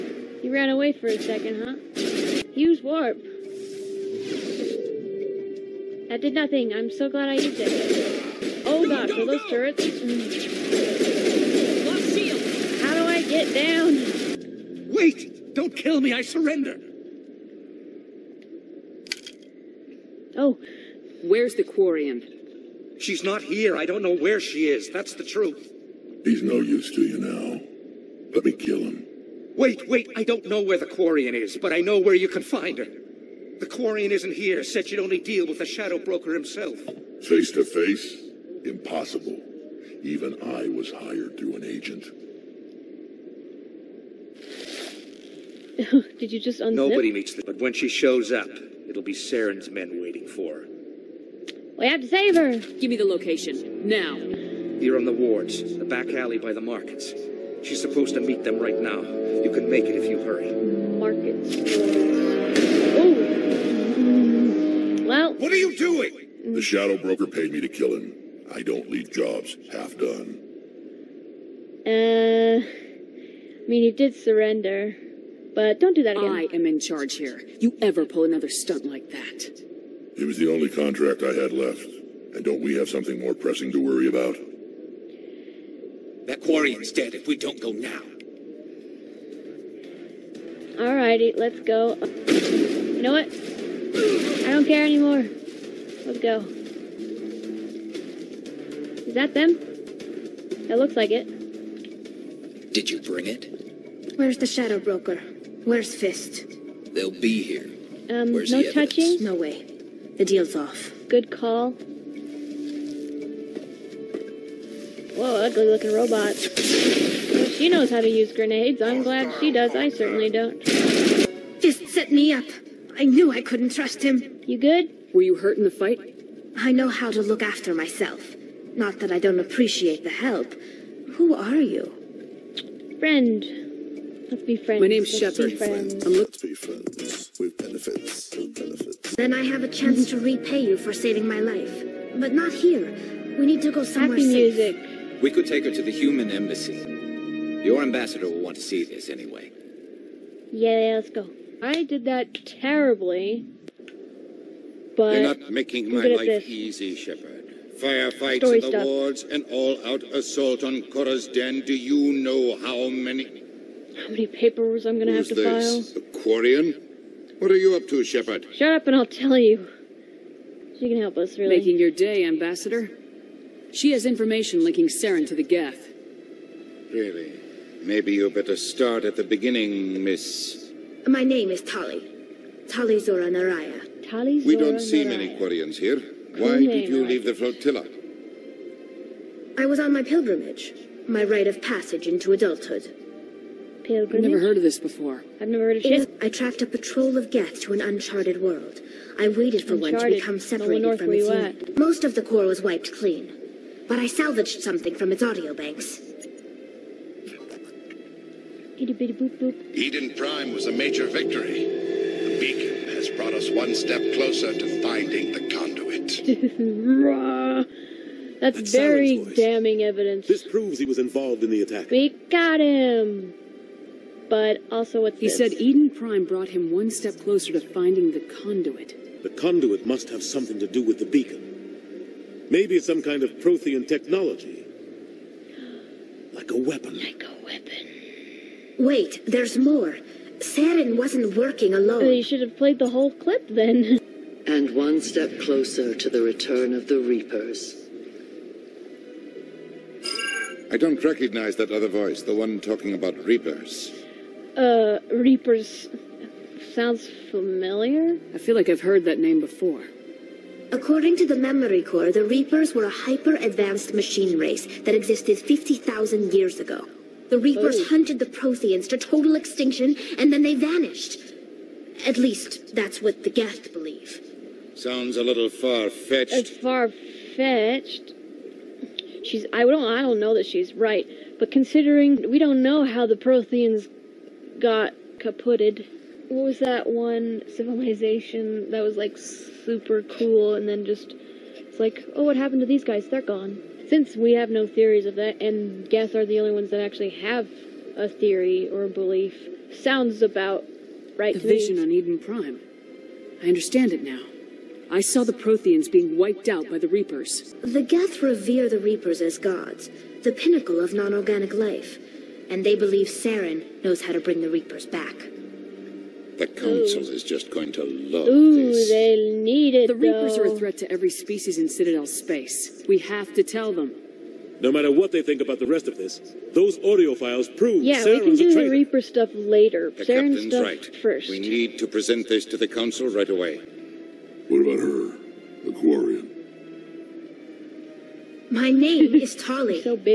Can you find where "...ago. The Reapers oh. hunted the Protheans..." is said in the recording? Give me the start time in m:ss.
4:26.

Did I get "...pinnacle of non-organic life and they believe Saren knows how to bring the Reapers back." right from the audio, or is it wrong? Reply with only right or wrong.
right.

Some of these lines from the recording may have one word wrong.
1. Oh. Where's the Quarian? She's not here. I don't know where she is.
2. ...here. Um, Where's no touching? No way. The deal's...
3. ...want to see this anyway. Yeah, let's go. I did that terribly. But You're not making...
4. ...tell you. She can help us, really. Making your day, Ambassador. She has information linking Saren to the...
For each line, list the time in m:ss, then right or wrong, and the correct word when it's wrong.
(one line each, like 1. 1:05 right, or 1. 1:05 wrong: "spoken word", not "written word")
1. 0:20 right
2. 1:47 right
3. 2:28 right
4. 2:49 right.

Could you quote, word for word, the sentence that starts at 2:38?
wards, an all-out assault on Chora's den.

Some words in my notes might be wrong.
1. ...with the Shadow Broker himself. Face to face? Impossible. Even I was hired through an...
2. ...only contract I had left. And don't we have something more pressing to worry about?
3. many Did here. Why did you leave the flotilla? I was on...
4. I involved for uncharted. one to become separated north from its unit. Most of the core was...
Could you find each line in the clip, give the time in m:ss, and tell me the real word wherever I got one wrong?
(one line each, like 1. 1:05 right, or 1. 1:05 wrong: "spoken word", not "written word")
1. 0:35 right
2. 1:20 right
3. 3:05 wrong: "Quarians", not "Did"
4. 3:19 wrong: "waited", not "involved".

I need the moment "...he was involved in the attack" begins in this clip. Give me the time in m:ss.
3:40.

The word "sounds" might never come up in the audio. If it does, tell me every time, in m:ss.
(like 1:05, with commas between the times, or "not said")
4:16, 4:34, 4:59.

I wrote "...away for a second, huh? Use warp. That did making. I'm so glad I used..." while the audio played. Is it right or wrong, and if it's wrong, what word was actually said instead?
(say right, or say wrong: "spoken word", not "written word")
wrong: "nothing", not "making".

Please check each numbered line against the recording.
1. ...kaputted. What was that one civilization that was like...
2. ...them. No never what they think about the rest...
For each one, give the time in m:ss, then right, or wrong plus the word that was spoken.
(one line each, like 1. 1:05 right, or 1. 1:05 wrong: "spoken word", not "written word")
1. 4:45 right
2. 5:23 wrong: "matter", not "never".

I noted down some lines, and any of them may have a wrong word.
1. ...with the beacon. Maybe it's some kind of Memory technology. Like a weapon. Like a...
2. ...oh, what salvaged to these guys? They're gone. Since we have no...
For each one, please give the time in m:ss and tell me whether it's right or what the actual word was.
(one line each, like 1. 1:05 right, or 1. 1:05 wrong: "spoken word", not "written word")
1. 3:50 wrong: "Prothean", not "Memory"
2. 4:52 wrong: "happened", not "salvaged".